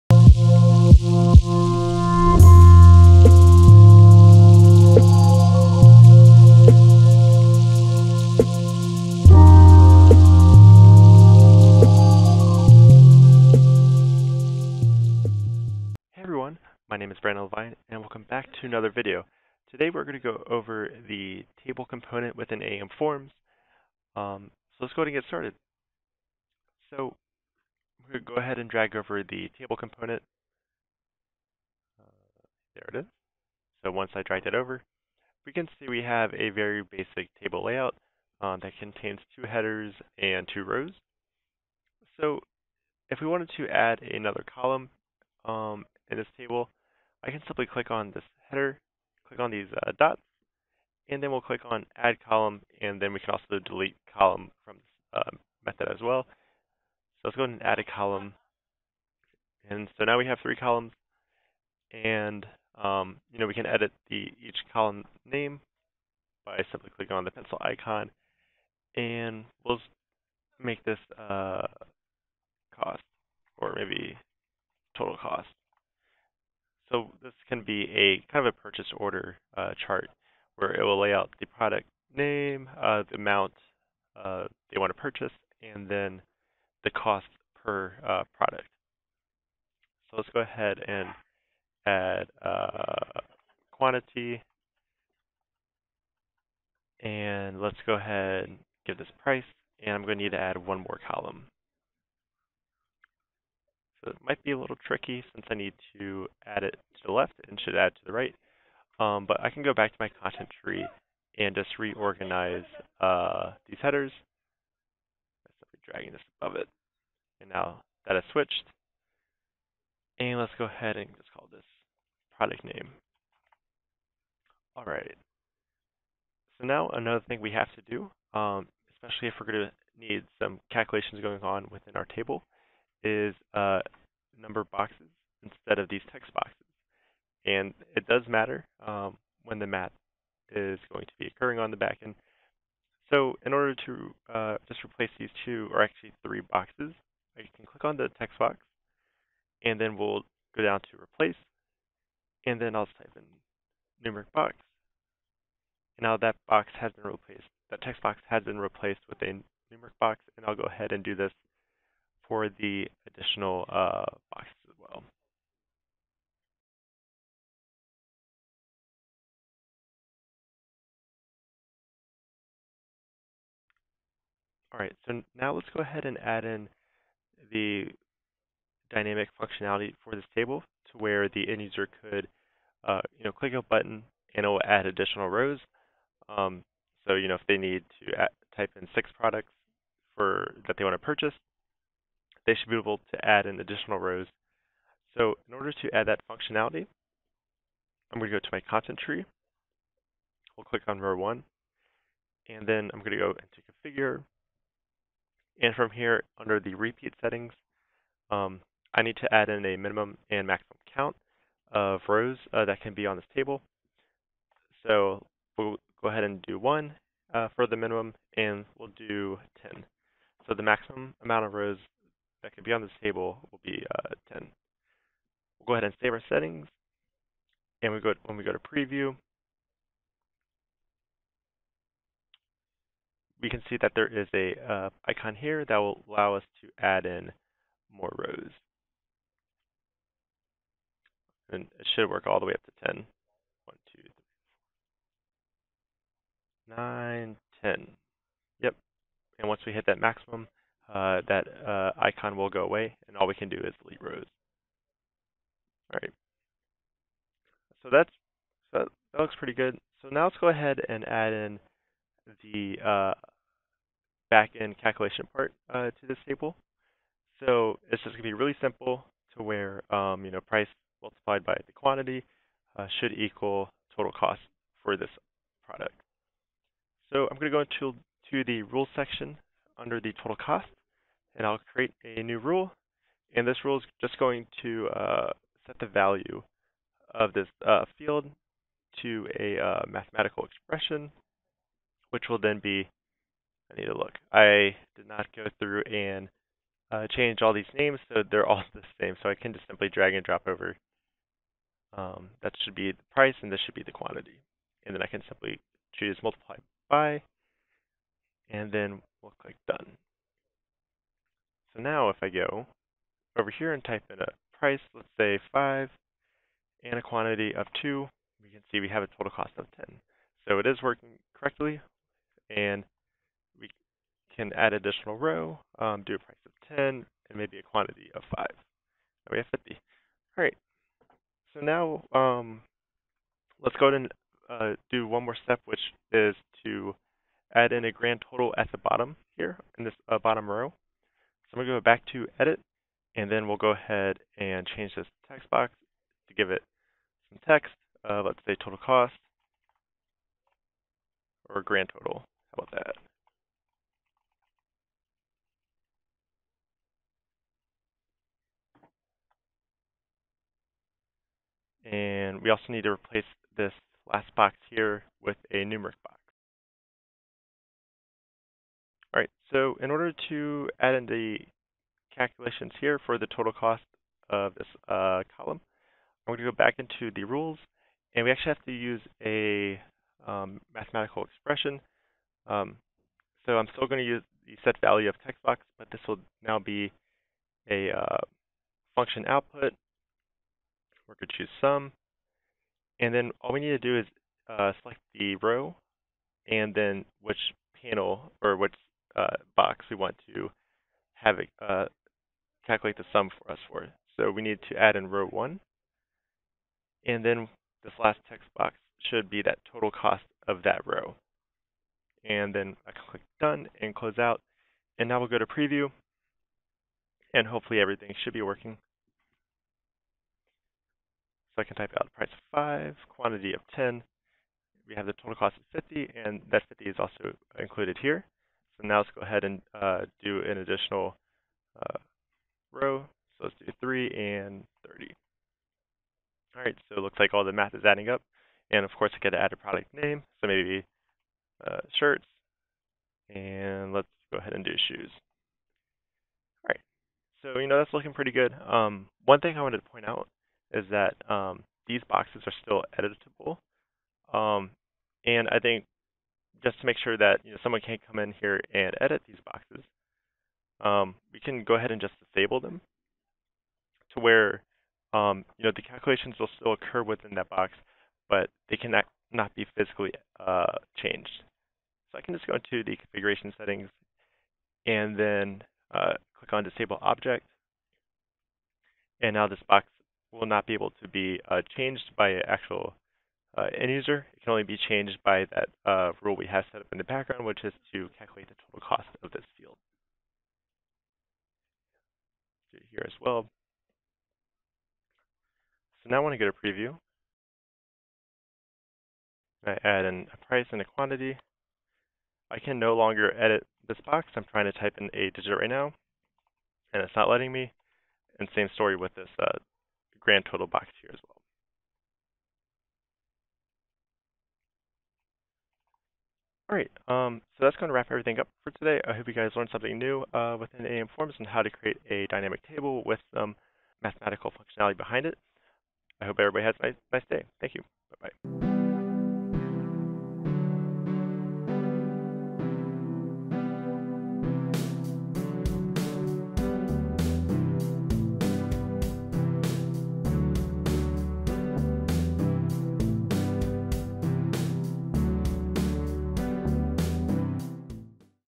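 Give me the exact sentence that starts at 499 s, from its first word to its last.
I add in a price and a quantity.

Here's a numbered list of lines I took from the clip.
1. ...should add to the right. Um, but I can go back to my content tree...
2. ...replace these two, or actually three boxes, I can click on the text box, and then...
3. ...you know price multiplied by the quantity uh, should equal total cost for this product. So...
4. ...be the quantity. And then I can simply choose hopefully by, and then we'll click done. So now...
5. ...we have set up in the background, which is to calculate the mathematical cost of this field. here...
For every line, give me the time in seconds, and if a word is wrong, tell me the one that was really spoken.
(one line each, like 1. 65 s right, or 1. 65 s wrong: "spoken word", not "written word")
1. 107 s right
2. 144 s right
3. 270 s right
4. 303 s wrong: "multiply", not "hopefully"
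5. 486 s wrong: "total", not "mathematical".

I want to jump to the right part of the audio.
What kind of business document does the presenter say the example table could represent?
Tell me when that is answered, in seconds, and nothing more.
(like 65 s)
78 s.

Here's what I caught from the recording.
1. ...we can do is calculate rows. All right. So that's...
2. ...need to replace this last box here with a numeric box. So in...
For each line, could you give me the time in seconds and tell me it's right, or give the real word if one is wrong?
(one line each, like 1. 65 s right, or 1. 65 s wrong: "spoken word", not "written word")
1. 253 s wrong: "delete", not "calculate"
2. 362 s right.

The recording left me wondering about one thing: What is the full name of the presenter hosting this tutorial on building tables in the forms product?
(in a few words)
Brandon Levine.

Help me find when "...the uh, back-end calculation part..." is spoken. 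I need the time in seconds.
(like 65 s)
262 s.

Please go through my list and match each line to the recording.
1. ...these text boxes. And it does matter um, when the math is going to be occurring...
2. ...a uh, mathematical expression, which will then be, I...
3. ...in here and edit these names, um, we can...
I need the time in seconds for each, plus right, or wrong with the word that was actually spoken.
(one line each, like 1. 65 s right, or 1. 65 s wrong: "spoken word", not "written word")
1. 135 s right
2. 289 s right
3. 458 s wrong: "boxes", not "names".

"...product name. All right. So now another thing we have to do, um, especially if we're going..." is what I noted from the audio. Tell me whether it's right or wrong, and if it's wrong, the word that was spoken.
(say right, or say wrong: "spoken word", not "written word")
right.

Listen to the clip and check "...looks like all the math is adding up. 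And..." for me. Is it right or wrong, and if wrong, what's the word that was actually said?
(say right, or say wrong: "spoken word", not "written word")
right.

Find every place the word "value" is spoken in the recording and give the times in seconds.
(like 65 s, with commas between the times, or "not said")
285 s, 384 s.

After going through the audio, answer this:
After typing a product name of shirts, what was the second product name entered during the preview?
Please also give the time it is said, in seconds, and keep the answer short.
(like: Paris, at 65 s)
Shoes, at 444 s.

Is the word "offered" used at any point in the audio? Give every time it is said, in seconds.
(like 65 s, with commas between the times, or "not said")
not said.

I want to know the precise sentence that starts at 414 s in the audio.
And now we'll go to Preview.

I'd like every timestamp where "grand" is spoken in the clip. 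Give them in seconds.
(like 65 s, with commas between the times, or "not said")
337 s, 351 s, 510 s.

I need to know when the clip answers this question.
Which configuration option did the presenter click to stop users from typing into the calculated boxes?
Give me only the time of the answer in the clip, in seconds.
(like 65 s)
476 s.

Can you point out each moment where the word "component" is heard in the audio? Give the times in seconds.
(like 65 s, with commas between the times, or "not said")
21 s, 29 s.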